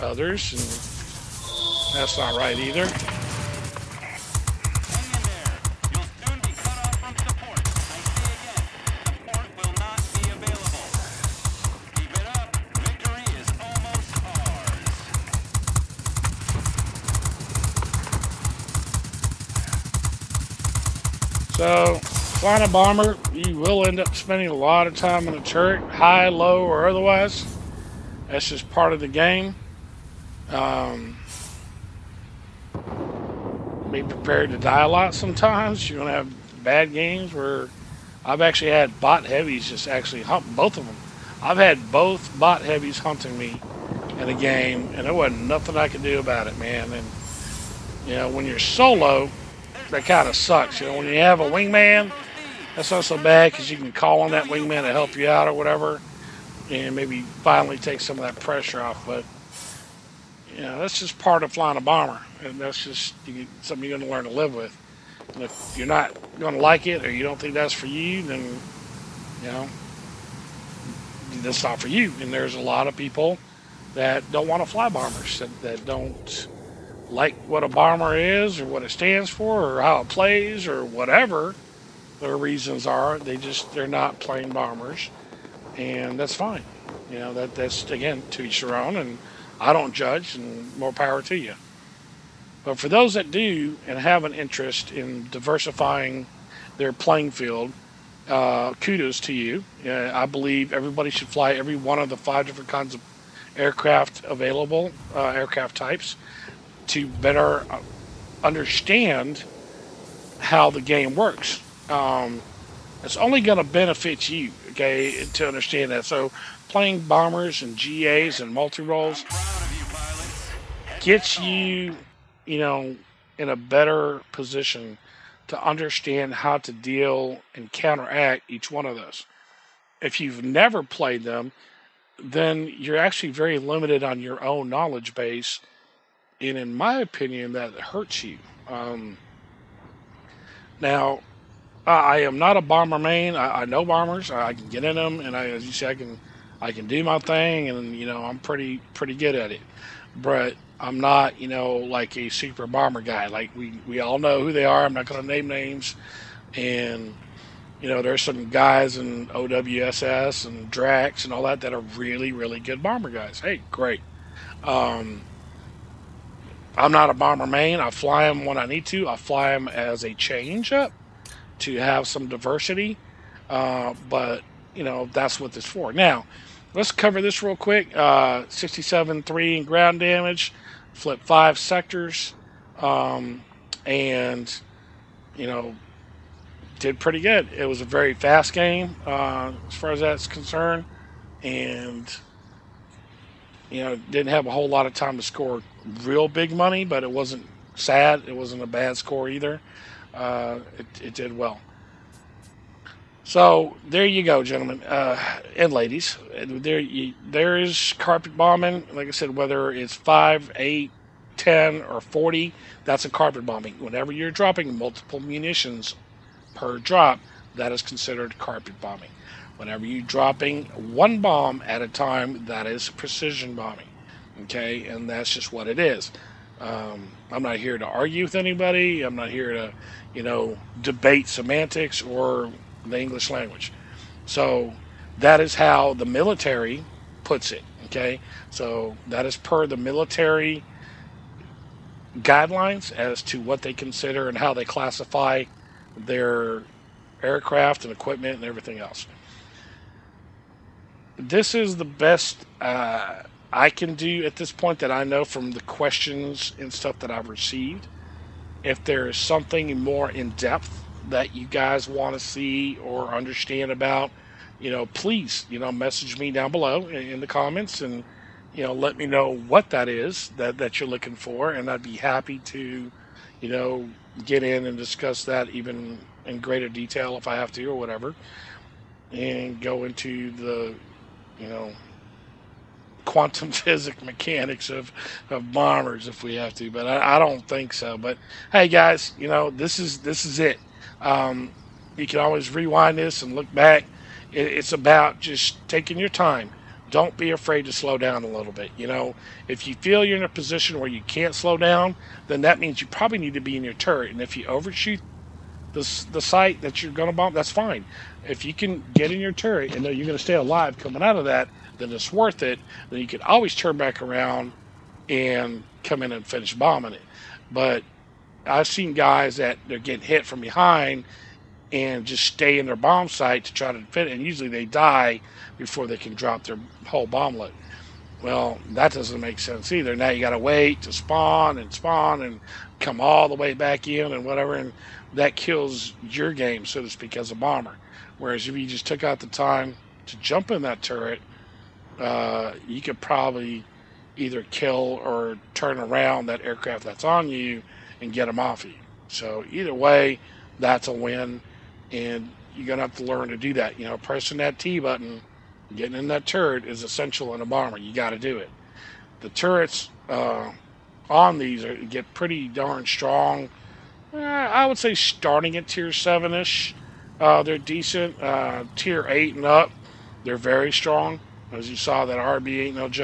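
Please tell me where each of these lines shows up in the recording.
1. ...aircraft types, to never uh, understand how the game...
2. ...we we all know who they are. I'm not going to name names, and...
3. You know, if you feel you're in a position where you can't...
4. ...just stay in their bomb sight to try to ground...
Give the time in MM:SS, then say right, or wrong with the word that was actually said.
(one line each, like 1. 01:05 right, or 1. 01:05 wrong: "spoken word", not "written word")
1. 01:45 wrong: "better", not "never"
2. 02:33 right
3. 04:58 right
4. 05:22 wrong: "defend", not "ground".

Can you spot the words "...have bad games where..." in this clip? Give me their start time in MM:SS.
00:36.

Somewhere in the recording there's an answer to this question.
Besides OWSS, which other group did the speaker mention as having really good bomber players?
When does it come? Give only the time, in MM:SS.
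02:40.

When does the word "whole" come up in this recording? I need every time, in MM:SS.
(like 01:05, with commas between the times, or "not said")
03:14, 05:26.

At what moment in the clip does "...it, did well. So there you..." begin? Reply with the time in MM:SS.
03:21.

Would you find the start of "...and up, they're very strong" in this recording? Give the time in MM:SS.
06:09.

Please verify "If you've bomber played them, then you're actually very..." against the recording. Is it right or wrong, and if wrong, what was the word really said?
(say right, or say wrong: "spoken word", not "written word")
wrong: "never", not "bomber".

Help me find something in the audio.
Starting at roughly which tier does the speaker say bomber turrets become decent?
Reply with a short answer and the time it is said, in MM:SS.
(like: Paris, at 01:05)
Tier 7, at 06:05.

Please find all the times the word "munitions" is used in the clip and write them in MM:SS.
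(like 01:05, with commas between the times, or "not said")
03:35.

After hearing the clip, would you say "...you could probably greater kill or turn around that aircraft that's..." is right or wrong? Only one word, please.
wrong.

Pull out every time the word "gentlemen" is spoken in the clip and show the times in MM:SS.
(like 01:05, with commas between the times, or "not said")
03:24.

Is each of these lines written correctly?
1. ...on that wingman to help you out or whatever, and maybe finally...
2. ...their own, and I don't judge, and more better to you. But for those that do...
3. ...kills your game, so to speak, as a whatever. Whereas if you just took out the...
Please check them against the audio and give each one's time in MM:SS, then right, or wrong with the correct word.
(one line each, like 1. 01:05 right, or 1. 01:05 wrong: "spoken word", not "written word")
1. 00:54 right
2. 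01:28 wrong: "power", not "better"
3. 05:35 wrong: "bomber", not "whatever".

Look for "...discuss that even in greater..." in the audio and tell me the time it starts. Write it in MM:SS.
04:34.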